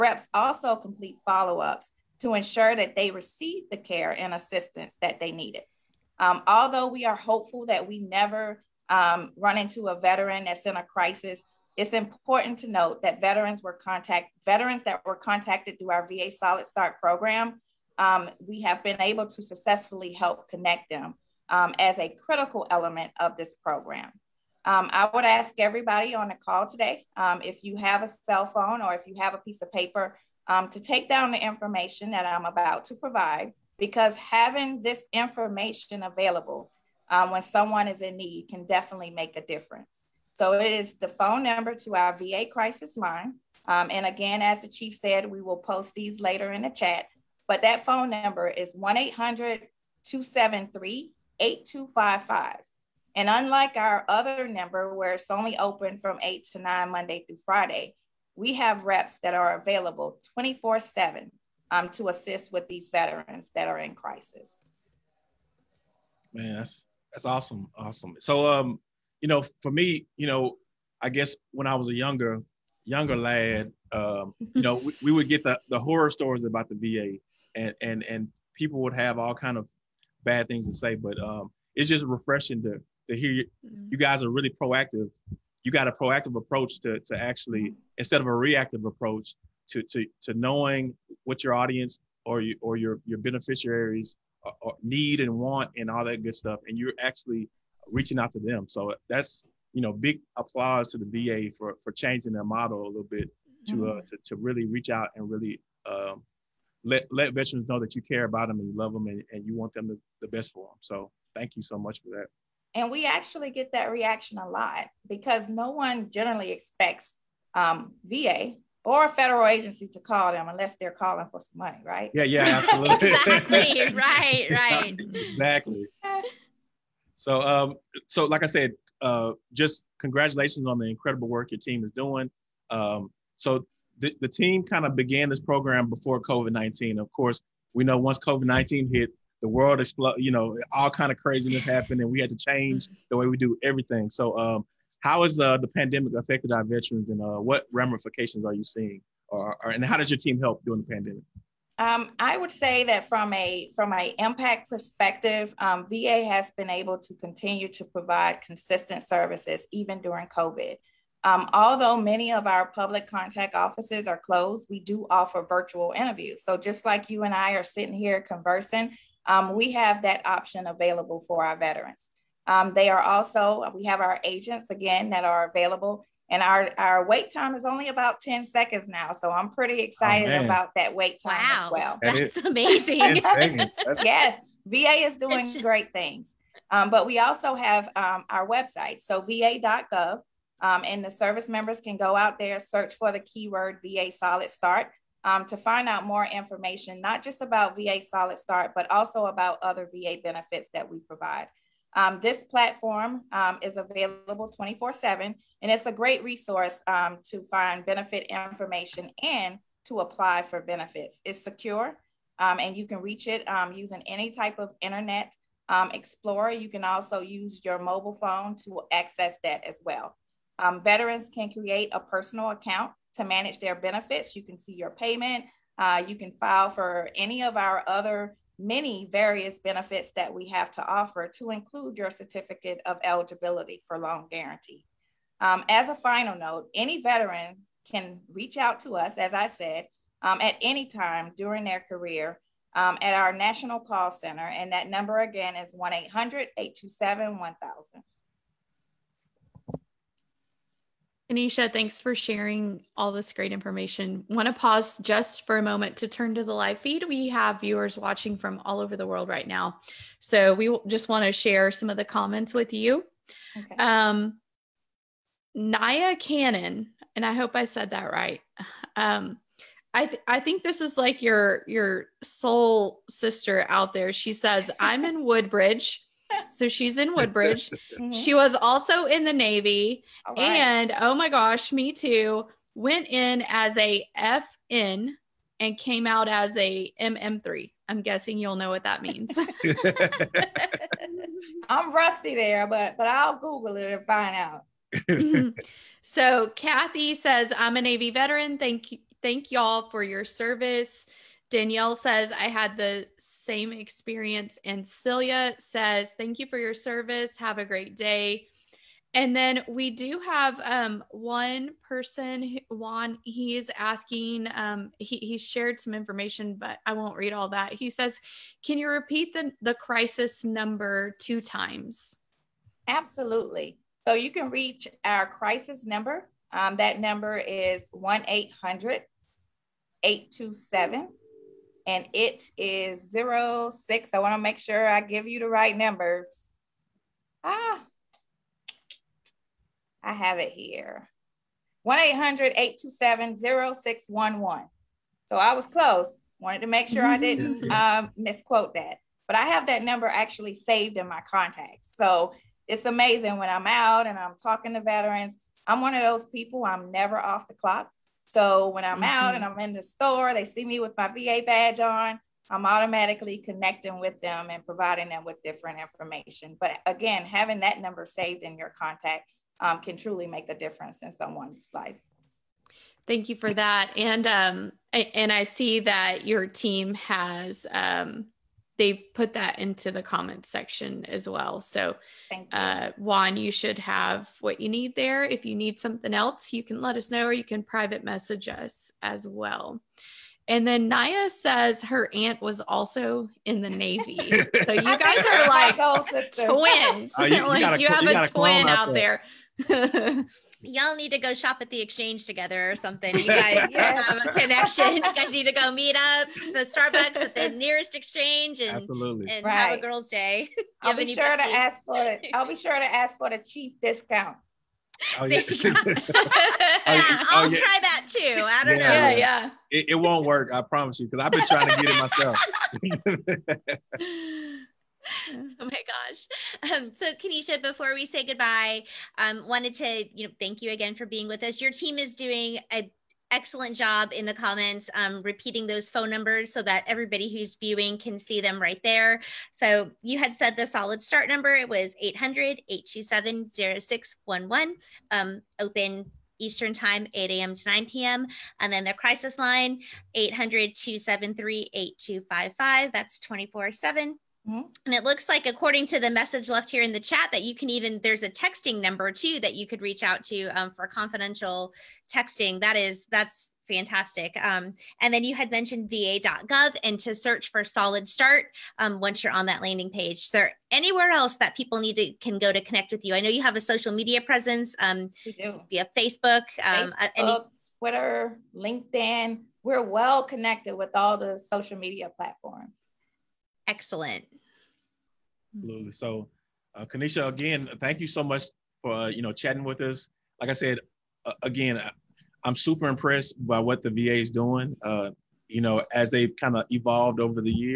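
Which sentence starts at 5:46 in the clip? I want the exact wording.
Wanted to make sure I mm-hmm.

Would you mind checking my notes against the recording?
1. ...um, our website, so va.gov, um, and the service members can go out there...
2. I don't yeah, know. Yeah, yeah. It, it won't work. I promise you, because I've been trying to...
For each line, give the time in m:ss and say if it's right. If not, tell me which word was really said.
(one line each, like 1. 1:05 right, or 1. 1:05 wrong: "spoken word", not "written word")
1. 3:07 right
2. 6:58 right.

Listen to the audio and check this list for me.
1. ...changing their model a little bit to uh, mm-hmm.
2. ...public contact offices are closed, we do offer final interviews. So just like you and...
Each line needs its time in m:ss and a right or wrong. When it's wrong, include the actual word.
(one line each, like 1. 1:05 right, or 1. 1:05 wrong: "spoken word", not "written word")
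1. 1:41 right
2. 2:42 wrong: "virtual", not "final".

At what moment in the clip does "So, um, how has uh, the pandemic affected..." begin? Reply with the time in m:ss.
2:24.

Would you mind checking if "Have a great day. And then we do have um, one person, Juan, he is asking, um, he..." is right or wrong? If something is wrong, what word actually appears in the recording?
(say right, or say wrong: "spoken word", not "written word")
right.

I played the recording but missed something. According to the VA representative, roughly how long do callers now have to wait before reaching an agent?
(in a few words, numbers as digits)
10 seconds.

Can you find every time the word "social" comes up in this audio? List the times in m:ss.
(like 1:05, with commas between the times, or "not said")
7:53, 8:01.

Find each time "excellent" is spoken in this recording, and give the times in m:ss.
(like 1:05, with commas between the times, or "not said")
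7:13, 8:03.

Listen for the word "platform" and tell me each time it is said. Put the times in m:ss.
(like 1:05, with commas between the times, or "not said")
3:22, 8:02.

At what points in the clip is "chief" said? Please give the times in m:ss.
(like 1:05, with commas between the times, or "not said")
0:44, 6:53.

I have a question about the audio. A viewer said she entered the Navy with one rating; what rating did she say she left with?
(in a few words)
MM3.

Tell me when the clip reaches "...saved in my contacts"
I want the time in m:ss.
5:50.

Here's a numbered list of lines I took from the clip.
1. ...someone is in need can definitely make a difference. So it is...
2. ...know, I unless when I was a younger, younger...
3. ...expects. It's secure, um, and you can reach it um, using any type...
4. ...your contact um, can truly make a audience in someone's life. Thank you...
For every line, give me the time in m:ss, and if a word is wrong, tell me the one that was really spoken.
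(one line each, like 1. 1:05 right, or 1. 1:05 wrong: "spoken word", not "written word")
1. 0:37 right
2. 1:10 wrong: "guess", not "unless"
3. 3:30 wrong: "benefits", not "expects"
4. 6:08 wrong: "difference", not "audience".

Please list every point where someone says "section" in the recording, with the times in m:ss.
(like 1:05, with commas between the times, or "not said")
6:20.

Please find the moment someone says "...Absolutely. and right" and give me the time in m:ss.
6:48.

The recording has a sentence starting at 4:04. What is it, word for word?
And that number again is 1 800 827 1000.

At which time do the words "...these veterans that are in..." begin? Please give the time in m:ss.
1:02.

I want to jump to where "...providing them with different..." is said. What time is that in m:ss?
6:04.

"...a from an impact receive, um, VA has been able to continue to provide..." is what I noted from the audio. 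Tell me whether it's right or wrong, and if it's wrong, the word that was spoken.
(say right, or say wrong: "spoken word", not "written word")
wrong: "perspective", not "receive".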